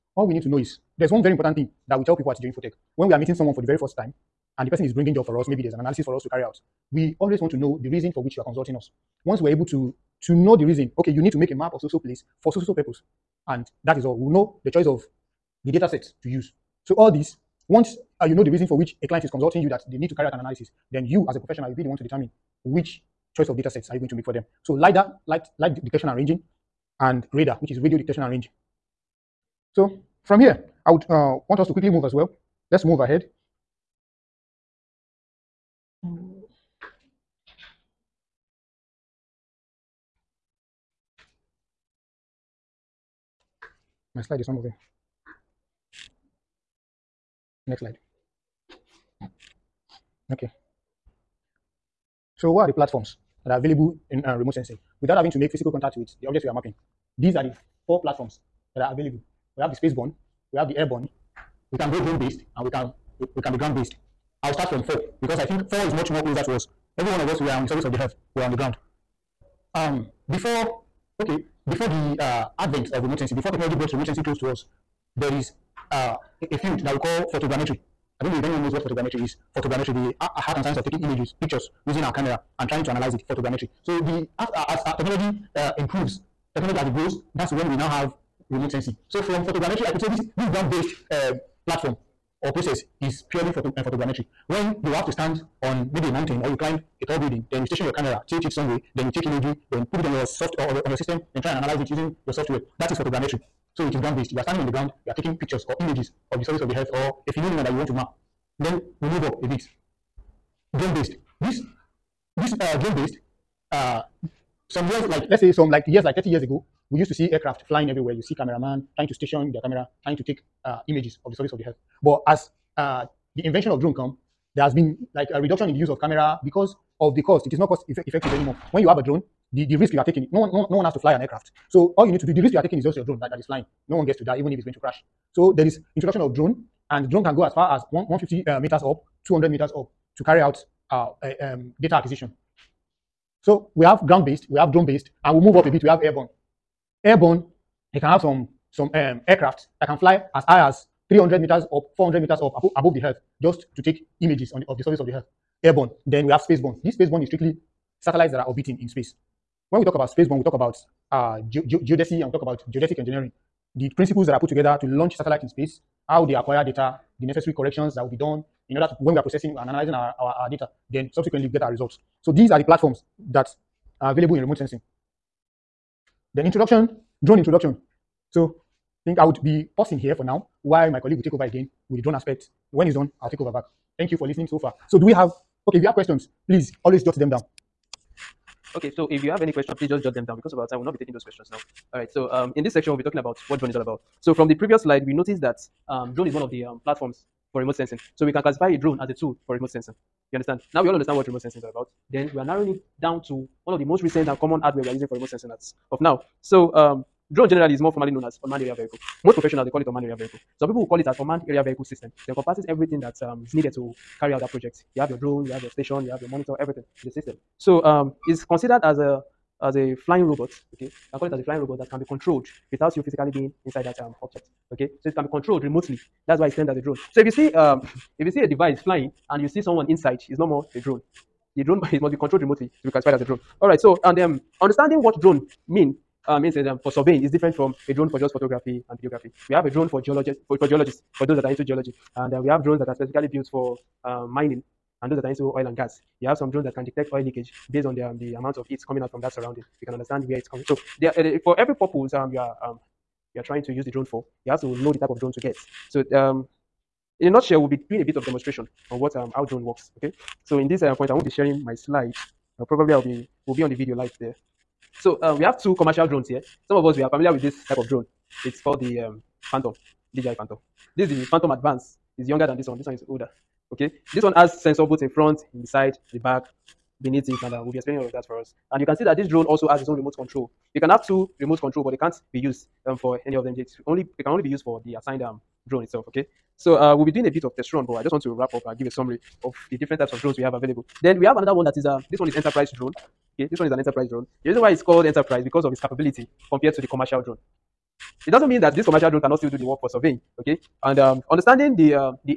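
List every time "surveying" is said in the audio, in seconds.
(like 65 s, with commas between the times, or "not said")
236 s, 299 s.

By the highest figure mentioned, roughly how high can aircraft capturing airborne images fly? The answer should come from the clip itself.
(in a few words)
400 meters.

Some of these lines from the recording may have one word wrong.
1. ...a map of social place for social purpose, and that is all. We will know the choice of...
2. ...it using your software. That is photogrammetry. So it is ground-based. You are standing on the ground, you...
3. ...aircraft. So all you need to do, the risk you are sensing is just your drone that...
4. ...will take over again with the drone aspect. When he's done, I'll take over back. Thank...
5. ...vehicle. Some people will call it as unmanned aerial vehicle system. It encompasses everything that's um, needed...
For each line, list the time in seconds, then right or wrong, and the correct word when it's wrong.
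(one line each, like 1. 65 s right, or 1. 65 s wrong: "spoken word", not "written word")
1. 11 s right
2. 101 s right
3. 131 s wrong: "taking", not "sensing"
4. 181 s right
5. 210 s right.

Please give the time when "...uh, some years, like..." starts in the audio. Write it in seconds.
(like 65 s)
113 s.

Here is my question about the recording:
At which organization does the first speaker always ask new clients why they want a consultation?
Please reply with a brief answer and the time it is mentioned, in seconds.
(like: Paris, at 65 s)
GeoInfotech, at 2 s.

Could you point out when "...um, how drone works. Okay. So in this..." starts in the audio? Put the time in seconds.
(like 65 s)
259 s.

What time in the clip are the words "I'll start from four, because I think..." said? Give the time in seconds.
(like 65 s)
64 s.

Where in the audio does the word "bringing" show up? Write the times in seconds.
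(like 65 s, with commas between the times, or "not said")
4 s.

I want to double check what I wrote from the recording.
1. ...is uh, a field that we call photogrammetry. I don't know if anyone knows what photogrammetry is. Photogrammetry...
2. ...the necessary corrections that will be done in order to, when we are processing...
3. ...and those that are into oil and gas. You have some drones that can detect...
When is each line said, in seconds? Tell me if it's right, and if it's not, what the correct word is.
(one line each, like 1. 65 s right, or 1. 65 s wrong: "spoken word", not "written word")
1. 75 s right
2. 167 s right
3. 245 s right.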